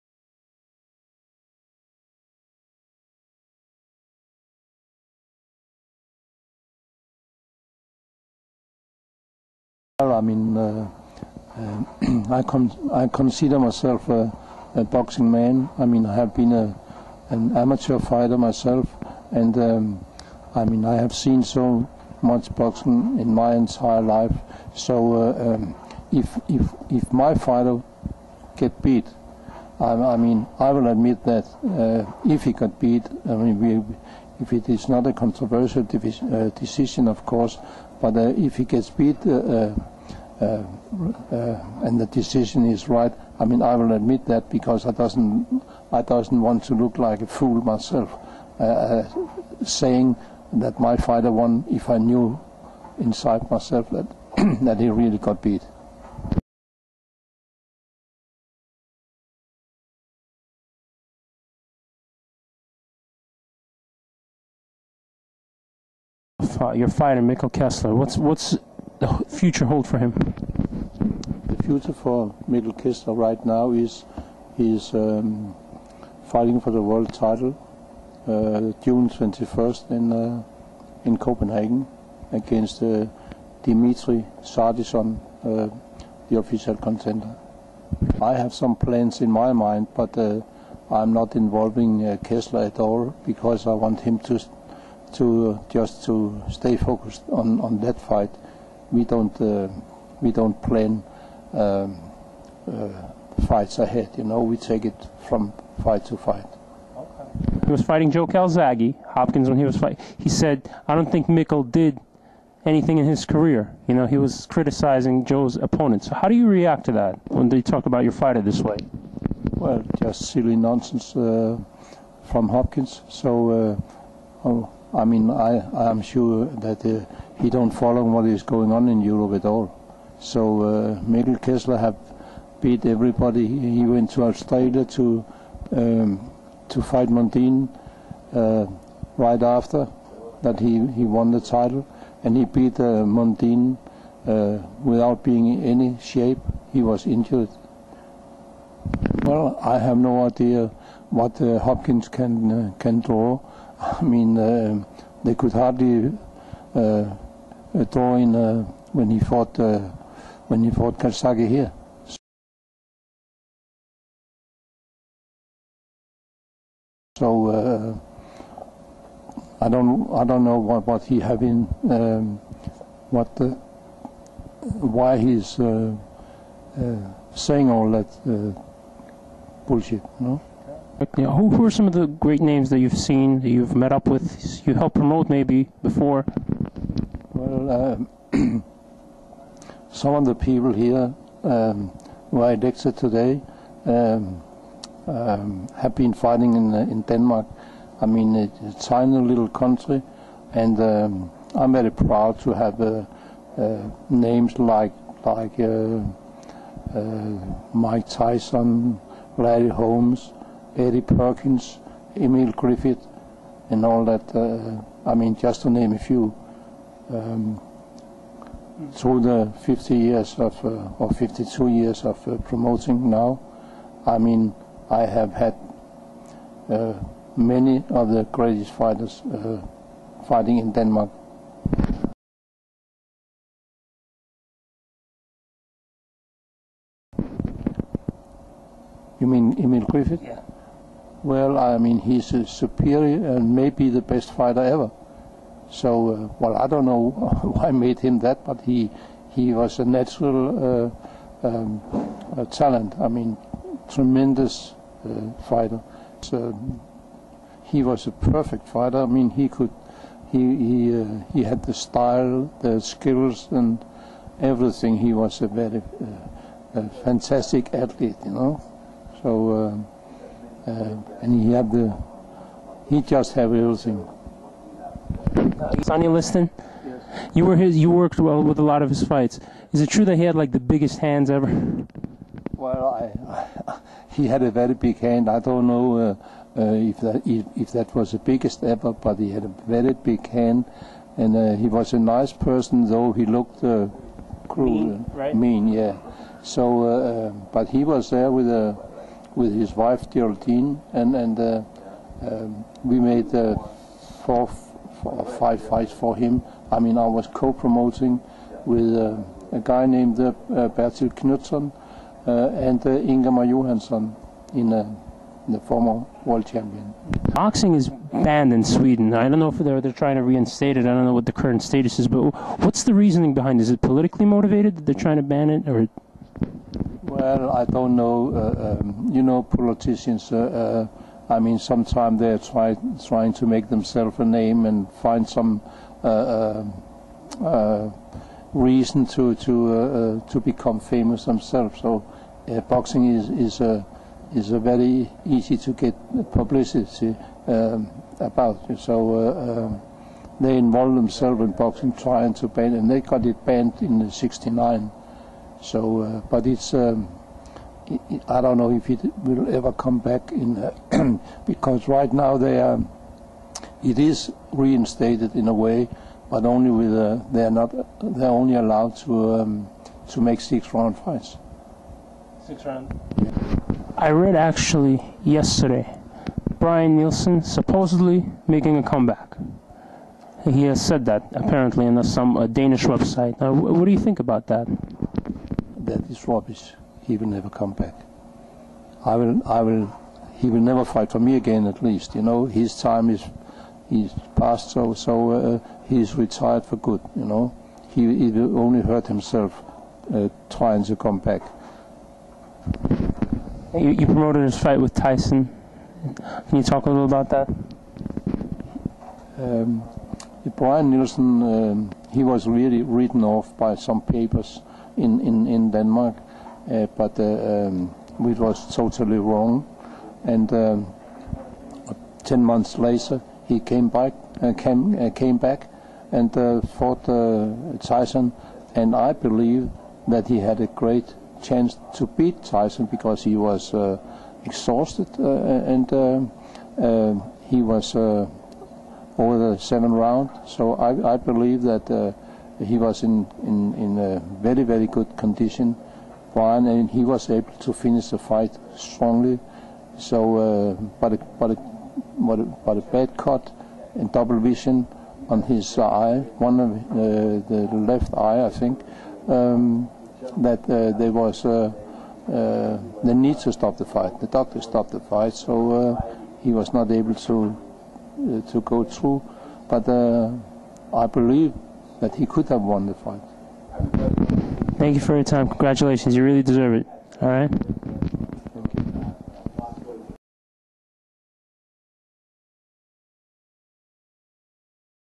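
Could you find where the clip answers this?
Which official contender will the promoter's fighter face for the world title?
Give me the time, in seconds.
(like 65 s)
83 s.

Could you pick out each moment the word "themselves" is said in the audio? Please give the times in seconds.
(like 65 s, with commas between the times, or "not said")
333 s, 341 s, 350 s.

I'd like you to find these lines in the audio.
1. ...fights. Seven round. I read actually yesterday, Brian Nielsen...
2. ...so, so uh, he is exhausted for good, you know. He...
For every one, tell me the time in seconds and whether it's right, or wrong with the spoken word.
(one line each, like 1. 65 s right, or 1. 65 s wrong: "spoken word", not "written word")
1. 370 s wrong: "Six", not "Seven"
2. 394 s wrong: "retired", not "exhausted".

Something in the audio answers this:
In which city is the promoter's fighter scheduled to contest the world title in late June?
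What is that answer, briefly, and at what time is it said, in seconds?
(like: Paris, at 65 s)
Copenhagen, at 81 s.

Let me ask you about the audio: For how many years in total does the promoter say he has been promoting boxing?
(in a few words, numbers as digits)
52.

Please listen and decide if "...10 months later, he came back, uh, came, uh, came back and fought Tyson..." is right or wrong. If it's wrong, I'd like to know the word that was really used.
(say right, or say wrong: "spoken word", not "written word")
right.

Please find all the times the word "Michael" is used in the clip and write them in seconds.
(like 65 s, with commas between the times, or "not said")
67 s, 72 s.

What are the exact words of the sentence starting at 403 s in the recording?
You, you promoted his fight with Tyson.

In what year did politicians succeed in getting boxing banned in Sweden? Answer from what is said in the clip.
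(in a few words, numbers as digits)
1969.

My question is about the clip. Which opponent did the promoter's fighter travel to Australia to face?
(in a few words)
Mundine.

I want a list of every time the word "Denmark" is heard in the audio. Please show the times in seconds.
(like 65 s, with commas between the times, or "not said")
197 s, 230 s, 415 s.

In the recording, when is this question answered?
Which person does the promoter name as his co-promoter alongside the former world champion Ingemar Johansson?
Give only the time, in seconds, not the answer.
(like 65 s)
310 s.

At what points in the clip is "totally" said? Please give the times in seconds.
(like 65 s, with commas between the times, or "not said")
418 s.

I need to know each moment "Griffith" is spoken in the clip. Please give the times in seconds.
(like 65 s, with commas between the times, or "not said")
212 s, 239 s.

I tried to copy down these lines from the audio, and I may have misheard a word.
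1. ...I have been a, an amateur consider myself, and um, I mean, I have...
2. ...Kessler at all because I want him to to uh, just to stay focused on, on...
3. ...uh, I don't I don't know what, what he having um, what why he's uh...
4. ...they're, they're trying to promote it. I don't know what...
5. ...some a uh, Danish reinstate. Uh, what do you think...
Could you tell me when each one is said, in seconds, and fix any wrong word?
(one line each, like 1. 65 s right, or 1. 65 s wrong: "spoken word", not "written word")
1. 16 s wrong: "fighter", not "consider"
2. 92 s right
3. 167 s right
4. 319 s wrong: "reinstate", not "promote"
5. 382 s wrong: "website", not "reinstate".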